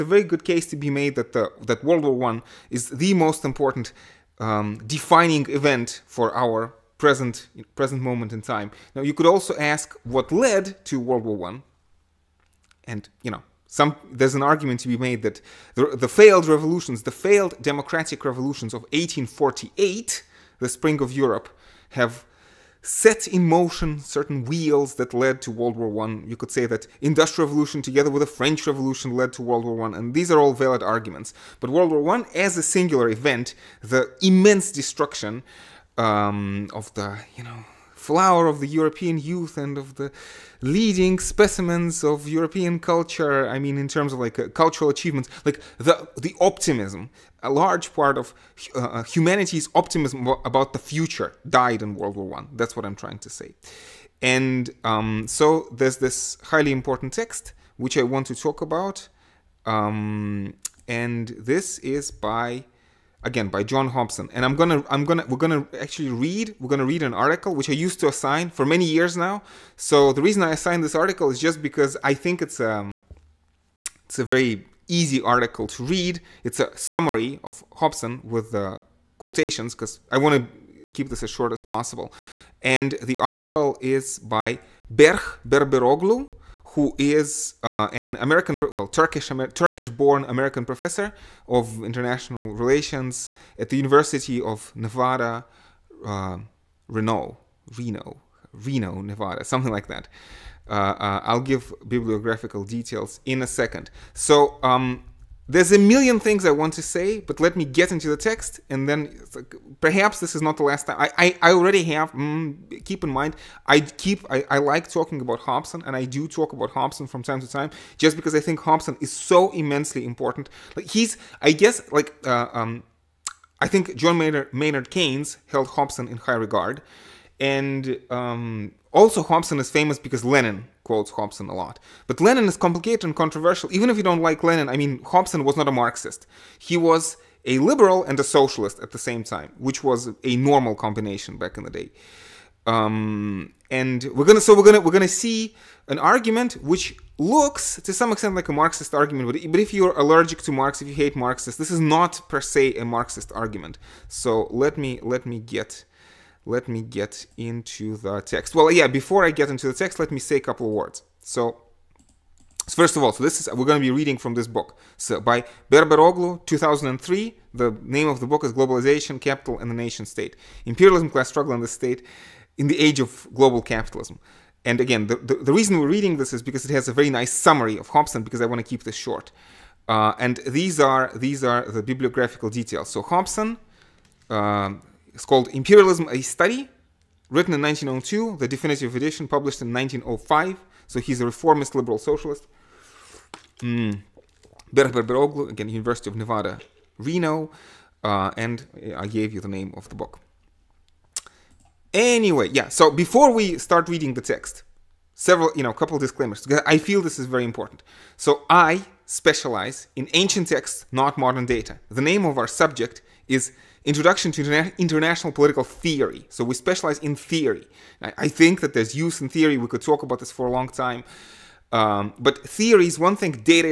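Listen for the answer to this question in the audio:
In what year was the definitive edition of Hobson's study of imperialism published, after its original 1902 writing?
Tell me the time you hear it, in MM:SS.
03:09.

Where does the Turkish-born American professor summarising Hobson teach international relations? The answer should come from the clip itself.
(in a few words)
University of Nevada, Reno.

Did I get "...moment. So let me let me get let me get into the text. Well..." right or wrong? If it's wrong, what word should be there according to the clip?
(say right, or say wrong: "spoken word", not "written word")
wrong: "argument", not "moment".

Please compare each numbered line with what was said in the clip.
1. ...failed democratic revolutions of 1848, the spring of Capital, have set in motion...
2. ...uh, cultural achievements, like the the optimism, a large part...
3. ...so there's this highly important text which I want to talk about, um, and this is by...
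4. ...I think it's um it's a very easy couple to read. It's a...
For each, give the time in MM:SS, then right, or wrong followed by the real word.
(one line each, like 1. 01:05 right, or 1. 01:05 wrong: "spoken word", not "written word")
1. 00:17 wrong: "Europe", not "Capital"
2. 00:44 right
3. 00:55 right
4. 01:12 wrong: "article", not "couple".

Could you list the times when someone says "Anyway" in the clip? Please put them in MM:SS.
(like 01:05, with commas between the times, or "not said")
03:21.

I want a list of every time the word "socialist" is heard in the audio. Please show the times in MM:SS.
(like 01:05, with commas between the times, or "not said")
02:18, 03:11.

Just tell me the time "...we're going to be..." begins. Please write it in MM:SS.
02:43.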